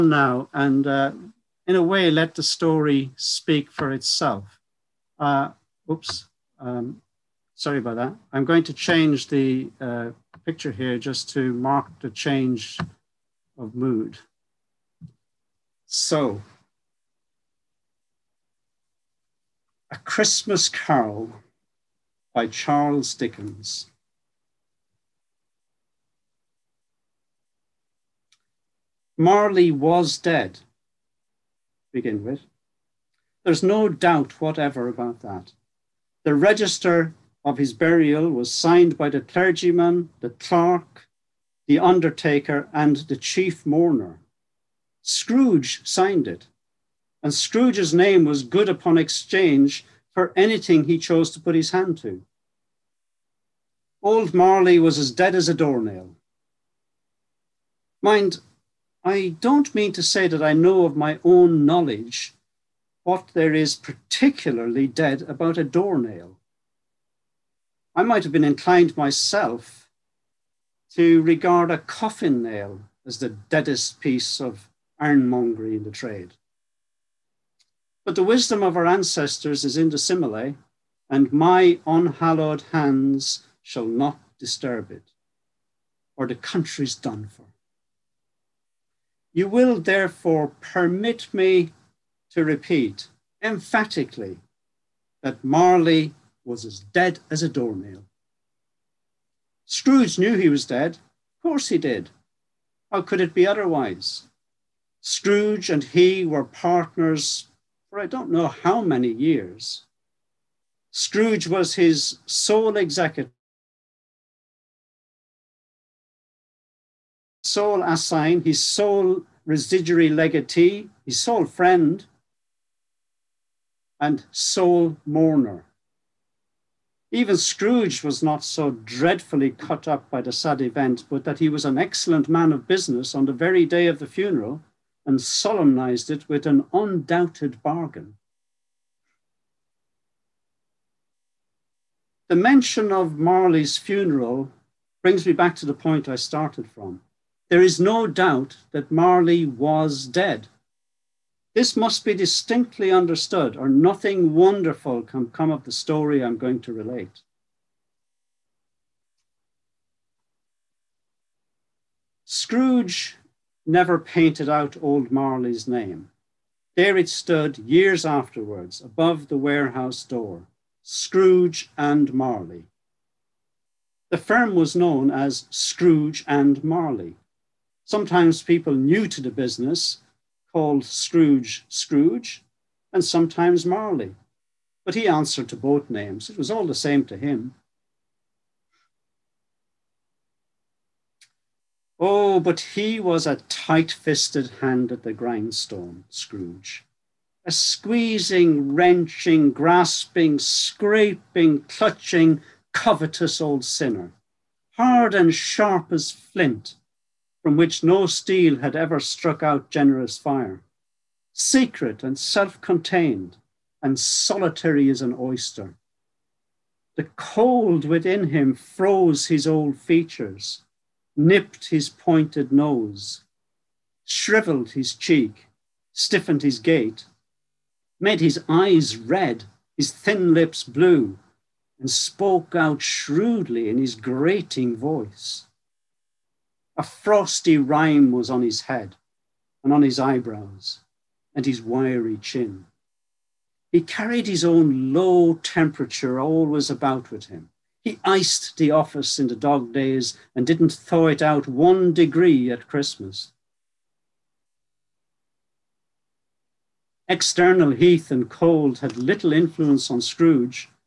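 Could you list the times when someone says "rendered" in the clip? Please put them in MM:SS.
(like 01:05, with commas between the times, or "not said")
not said.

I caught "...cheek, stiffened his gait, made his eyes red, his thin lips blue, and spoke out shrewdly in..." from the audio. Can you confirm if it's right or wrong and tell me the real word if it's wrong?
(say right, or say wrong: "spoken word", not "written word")
right.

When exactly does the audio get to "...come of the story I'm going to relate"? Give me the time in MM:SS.
02:35.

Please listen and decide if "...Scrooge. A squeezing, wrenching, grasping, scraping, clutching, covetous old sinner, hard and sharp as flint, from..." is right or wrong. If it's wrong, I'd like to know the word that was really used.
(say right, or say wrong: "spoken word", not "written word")
right.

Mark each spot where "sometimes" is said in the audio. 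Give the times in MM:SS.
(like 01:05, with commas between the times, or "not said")
02:57, 03:03.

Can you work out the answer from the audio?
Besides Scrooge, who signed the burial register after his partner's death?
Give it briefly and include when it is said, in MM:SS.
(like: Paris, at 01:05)
The chief mourner, at 00:42.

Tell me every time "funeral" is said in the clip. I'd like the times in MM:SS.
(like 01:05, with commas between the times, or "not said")
02:14, 02:23.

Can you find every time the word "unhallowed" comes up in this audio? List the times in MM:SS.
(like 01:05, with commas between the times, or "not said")
01:21.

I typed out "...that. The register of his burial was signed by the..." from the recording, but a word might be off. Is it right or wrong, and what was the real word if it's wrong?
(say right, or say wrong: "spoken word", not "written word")
right.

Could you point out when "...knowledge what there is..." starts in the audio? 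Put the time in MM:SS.
01:01.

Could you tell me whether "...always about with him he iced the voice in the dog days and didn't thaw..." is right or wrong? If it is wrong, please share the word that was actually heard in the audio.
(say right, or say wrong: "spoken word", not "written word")
wrong: "office", not "voice".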